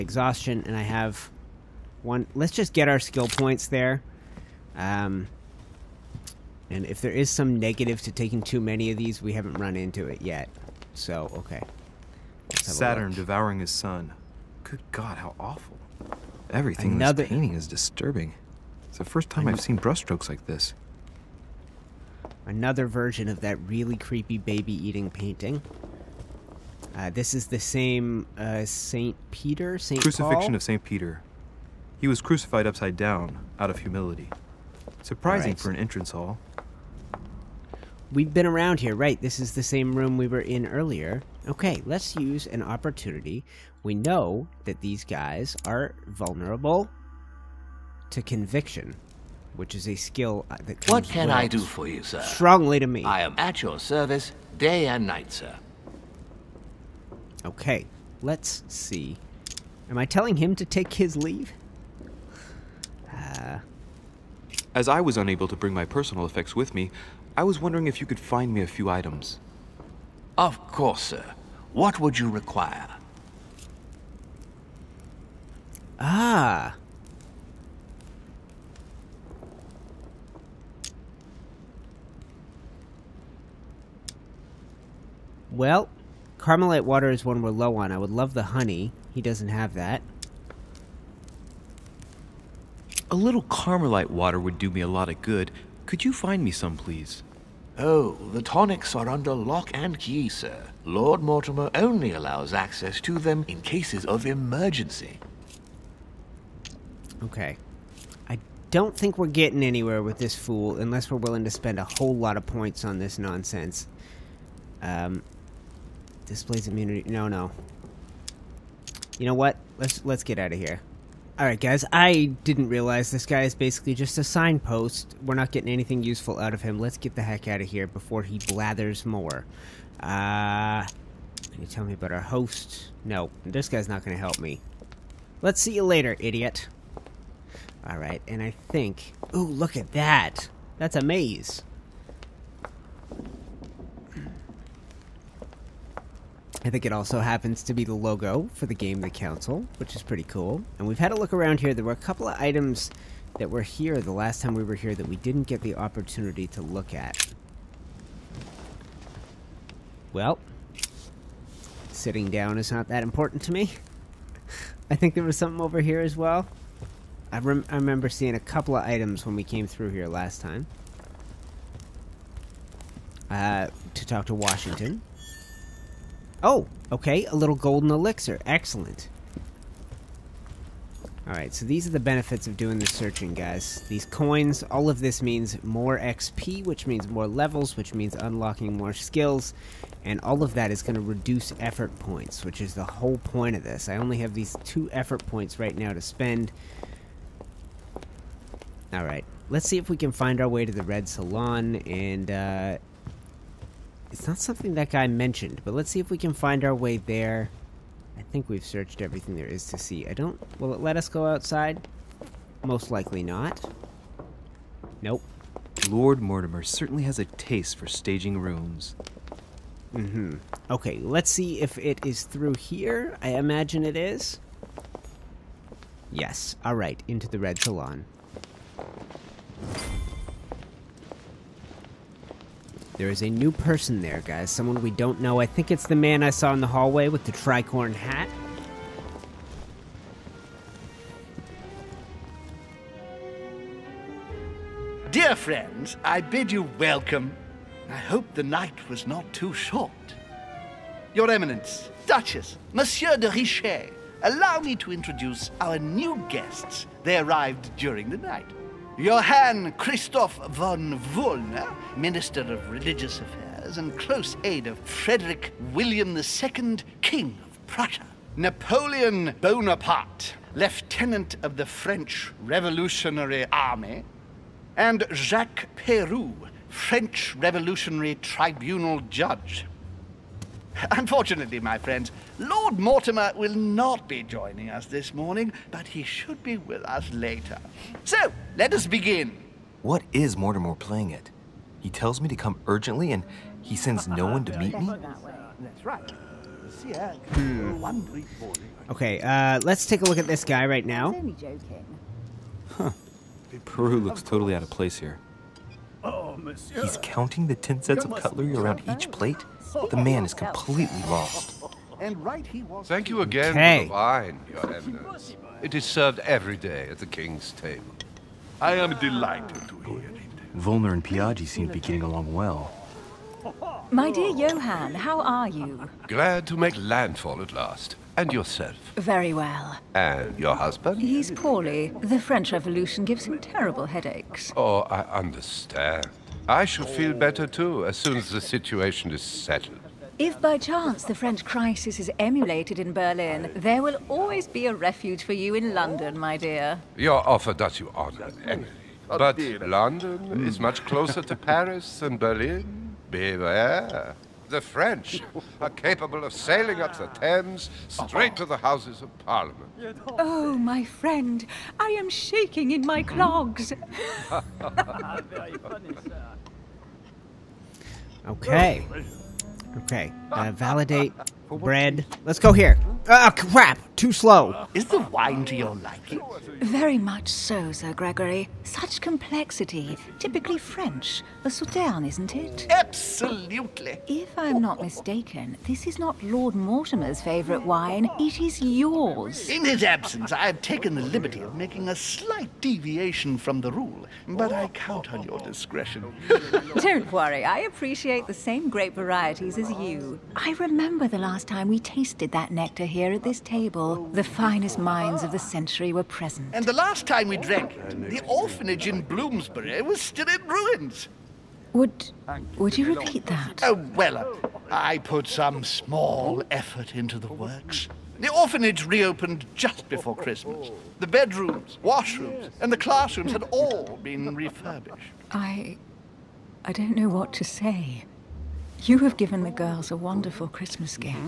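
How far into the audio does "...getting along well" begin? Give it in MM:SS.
05:21.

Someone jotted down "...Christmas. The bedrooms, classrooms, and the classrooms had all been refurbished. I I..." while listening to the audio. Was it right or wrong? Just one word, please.
wrong.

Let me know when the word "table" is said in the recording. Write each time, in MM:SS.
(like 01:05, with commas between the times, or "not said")
05:17, 06:43.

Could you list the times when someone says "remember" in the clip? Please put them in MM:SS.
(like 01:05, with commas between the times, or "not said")
02:47, 06:40.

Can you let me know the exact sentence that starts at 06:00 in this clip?
Oh, my friend, I am shaking in my clogs.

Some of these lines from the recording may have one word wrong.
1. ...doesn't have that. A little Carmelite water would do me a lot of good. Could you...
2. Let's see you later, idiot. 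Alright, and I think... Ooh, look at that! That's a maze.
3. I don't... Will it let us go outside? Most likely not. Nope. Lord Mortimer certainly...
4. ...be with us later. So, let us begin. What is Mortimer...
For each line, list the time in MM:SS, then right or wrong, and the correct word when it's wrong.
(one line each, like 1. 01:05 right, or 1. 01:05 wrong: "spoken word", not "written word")
1. 01:29 right
2. 02:15 right
3. 03:30 right
4. 04:46 right.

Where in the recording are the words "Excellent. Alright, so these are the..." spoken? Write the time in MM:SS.
02:58.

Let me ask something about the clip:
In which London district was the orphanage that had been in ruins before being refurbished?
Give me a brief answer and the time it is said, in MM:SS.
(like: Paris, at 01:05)
Bloomsbury, at 06:49.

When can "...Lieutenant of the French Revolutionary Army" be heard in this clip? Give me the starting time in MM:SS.
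04:30.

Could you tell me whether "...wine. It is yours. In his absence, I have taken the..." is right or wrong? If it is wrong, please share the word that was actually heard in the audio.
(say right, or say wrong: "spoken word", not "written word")
right.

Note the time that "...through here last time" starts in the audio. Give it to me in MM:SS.
02:49.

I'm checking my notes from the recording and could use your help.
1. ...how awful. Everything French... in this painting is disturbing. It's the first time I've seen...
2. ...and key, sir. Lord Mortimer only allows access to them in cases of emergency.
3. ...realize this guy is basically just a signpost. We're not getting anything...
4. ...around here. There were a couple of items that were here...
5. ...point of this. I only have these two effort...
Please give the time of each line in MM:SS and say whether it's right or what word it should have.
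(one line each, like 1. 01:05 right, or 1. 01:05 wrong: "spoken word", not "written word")
1. 00:15 wrong: "Another", not "French"
2. 01:39 right
3. 02:02 right
4. 02:31 right
5. 03:13 right.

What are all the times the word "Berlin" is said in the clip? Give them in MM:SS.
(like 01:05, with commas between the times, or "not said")
05:42, 05:52.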